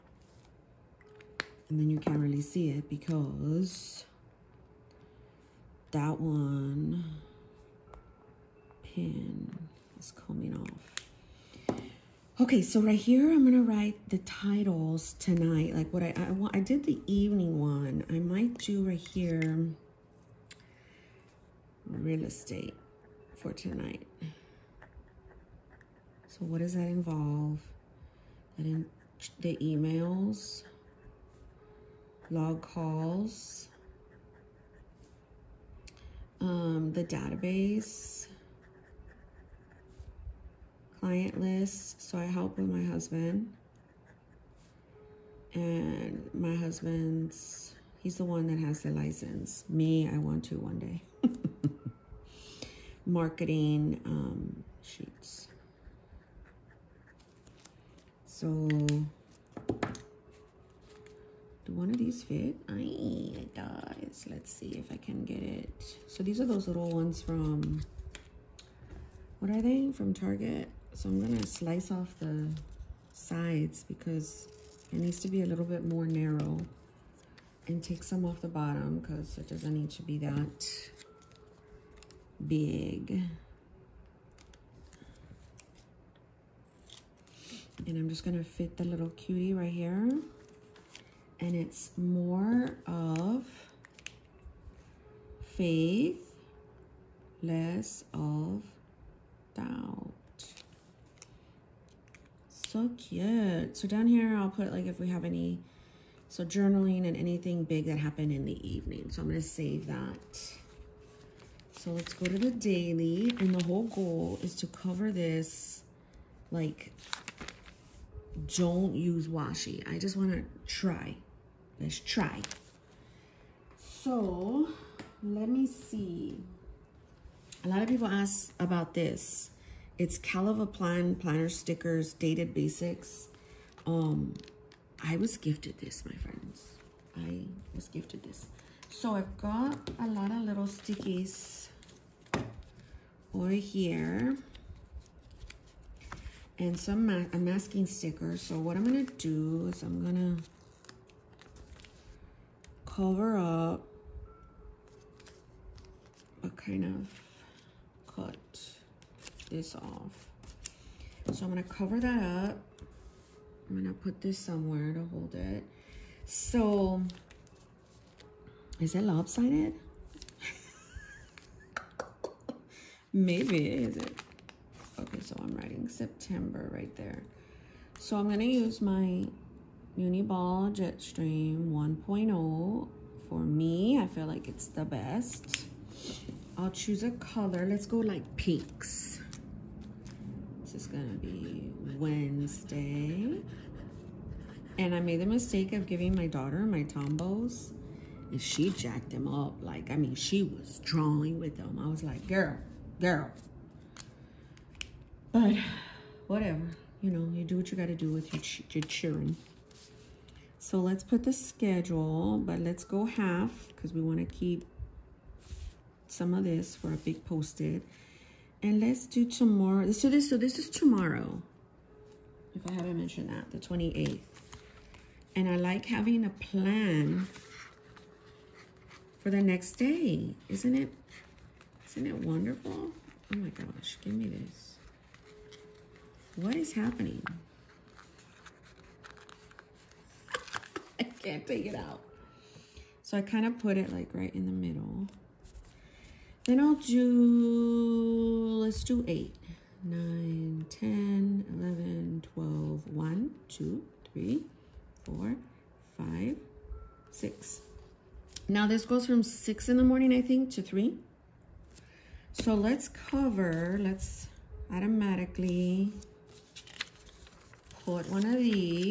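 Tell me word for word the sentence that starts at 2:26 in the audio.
And some ma a masking sticker.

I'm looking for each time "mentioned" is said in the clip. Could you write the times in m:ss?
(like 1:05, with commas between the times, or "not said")
3:42.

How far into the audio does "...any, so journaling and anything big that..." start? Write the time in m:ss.
1:45.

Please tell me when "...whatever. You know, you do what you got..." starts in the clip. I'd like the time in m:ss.
3:26.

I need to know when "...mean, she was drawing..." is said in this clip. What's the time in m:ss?
3:19.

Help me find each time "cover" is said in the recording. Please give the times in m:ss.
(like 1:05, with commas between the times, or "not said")
1:54, 2:32, 2:41, 4:22.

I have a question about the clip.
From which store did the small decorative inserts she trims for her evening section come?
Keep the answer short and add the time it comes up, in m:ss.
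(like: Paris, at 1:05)
Target, at 1:10.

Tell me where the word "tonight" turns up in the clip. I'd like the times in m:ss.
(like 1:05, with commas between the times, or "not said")
0:15, 0:23.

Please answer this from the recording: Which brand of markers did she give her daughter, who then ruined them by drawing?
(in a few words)
Tombows.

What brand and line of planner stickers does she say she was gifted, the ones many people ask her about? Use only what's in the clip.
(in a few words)
Caliva Plan Planner Stickers.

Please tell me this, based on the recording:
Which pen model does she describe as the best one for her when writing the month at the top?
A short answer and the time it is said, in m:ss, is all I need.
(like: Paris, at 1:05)
Uniball Jetstream 1.0, at 2:59.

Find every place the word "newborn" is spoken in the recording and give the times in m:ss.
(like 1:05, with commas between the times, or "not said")
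not said.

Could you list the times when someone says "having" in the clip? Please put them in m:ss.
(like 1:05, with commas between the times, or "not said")
3:45.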